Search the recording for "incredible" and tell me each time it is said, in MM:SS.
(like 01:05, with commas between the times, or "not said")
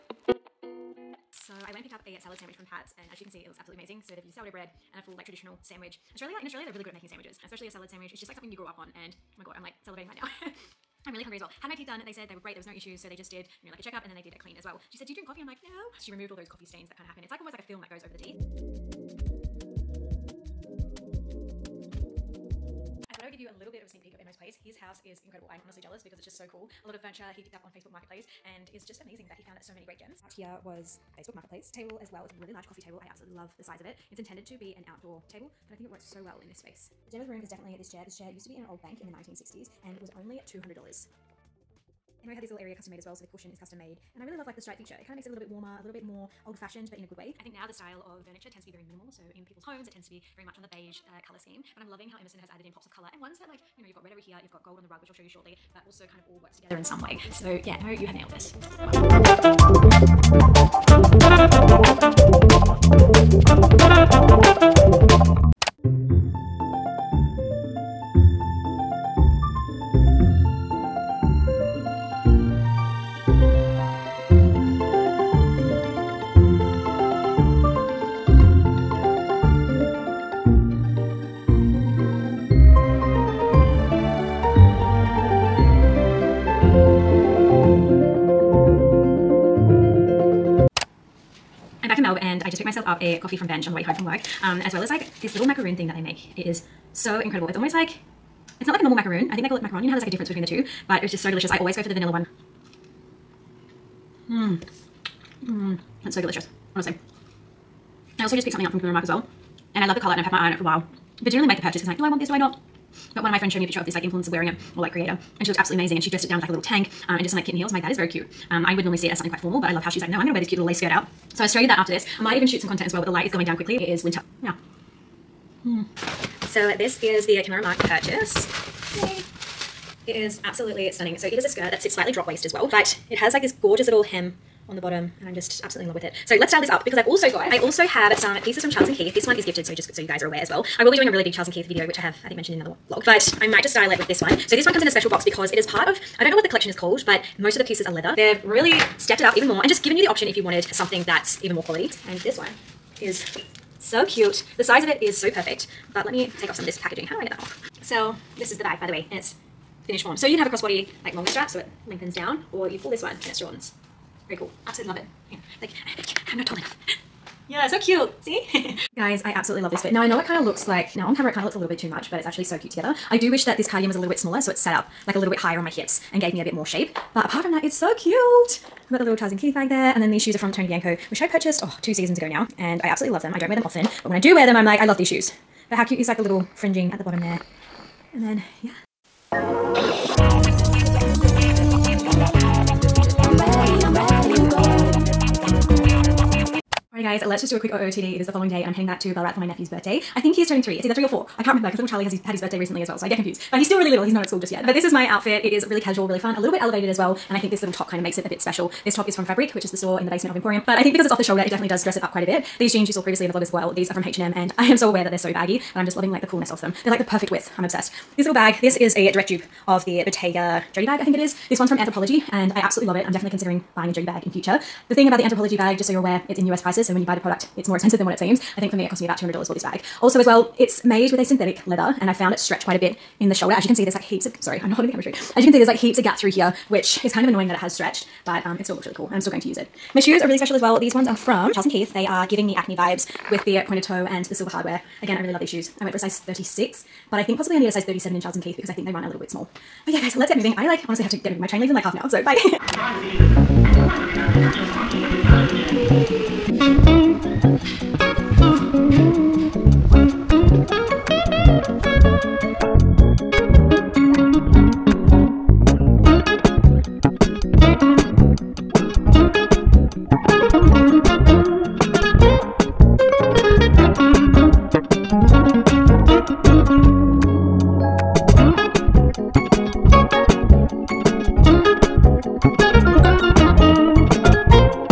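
00:25, 01:37.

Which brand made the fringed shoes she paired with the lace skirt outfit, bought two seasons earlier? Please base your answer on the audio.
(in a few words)
Tony Bianco.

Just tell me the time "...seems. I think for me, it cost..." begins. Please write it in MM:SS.
03:48.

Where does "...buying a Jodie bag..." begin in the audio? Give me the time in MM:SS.
03:43.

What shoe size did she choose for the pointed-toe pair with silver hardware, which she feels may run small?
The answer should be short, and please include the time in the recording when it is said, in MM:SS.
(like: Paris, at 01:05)
36, at 04:06.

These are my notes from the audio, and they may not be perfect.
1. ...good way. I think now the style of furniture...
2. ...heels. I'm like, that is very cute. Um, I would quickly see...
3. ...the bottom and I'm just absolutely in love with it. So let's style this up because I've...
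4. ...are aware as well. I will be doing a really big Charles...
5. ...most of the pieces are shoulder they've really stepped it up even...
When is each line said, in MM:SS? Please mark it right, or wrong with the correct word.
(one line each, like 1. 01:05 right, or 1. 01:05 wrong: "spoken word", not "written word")
1. 00:47 right
2. 01:57 wrong: "normally", not "quickly"
3. 02:14 right
4. 02:20 right
5. 02:27 wrong: "leather", not "shoulder".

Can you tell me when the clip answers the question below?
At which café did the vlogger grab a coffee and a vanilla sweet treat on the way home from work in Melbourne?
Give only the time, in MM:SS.
01:33.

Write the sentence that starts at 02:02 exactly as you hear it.
I might even shoot some content as well, but the light is going down quickly.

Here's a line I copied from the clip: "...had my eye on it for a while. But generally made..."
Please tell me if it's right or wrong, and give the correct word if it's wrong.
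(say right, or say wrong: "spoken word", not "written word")
right.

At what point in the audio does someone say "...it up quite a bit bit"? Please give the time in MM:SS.
03:31.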